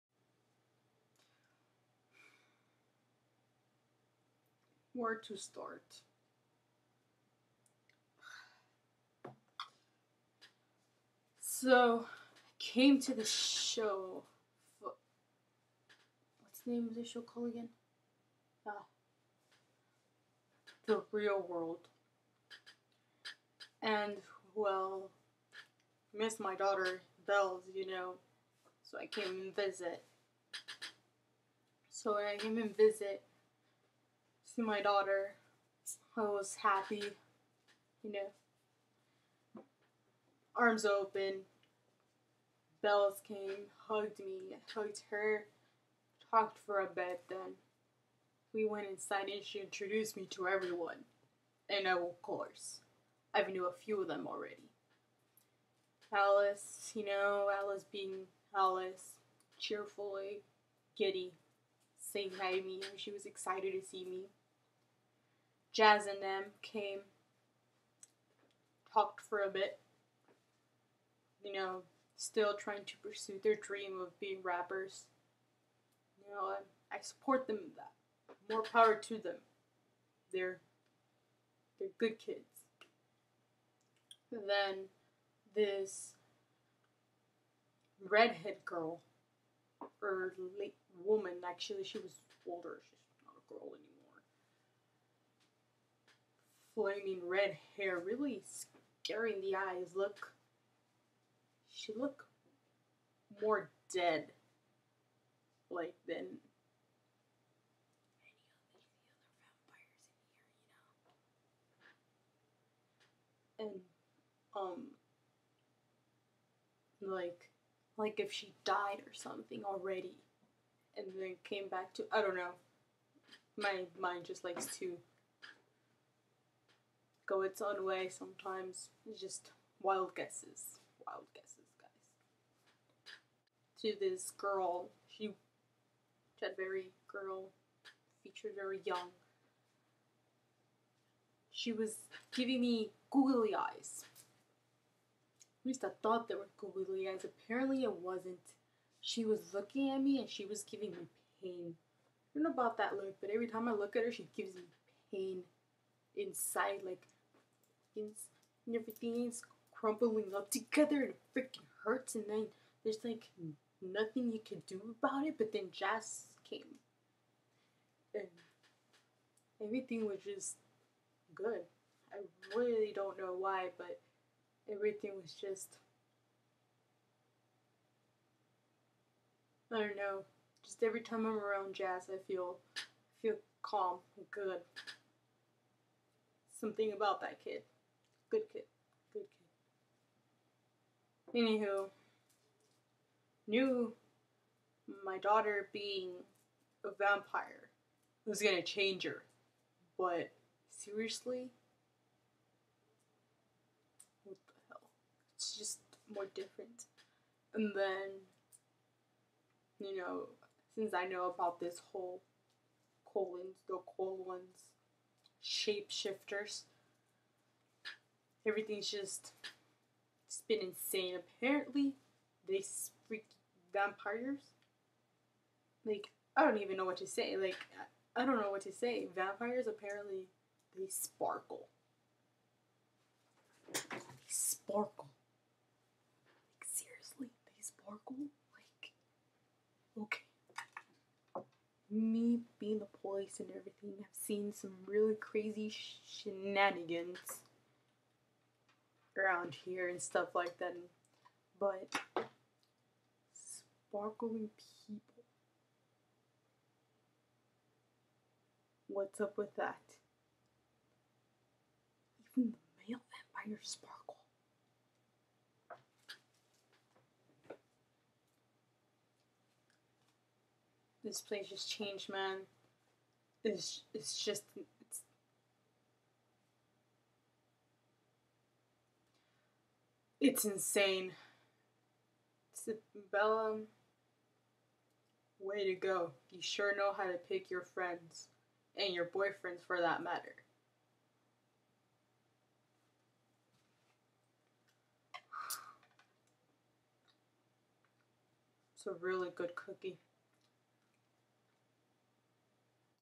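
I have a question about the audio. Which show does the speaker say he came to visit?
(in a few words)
The Real World.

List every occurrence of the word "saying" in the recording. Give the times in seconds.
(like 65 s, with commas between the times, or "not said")
62 s.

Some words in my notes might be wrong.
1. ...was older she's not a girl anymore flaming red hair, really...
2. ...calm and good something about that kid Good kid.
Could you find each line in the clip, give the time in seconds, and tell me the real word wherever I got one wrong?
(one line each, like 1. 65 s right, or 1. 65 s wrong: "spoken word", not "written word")
1. 91 s right
2. 183 s right.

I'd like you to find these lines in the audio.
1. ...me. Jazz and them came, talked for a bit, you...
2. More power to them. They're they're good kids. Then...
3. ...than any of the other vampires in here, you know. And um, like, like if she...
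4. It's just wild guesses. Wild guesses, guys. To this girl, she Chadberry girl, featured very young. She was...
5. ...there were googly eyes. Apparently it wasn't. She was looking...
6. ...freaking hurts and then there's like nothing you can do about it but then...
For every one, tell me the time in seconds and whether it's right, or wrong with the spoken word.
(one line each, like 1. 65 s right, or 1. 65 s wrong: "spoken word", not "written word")
1. 64 s right
2. 78 s right
3. 106 s right
4. 129 s right
5. 146 s right
6. 161 s right.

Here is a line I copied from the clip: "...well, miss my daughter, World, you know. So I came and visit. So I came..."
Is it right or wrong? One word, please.
wrong.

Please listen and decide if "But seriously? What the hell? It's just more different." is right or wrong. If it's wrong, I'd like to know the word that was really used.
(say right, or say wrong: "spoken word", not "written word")
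right.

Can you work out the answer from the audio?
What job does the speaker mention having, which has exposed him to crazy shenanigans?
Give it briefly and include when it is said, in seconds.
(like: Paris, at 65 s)
Police, at 242 s.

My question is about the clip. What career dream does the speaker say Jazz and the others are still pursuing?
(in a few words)
Rappers.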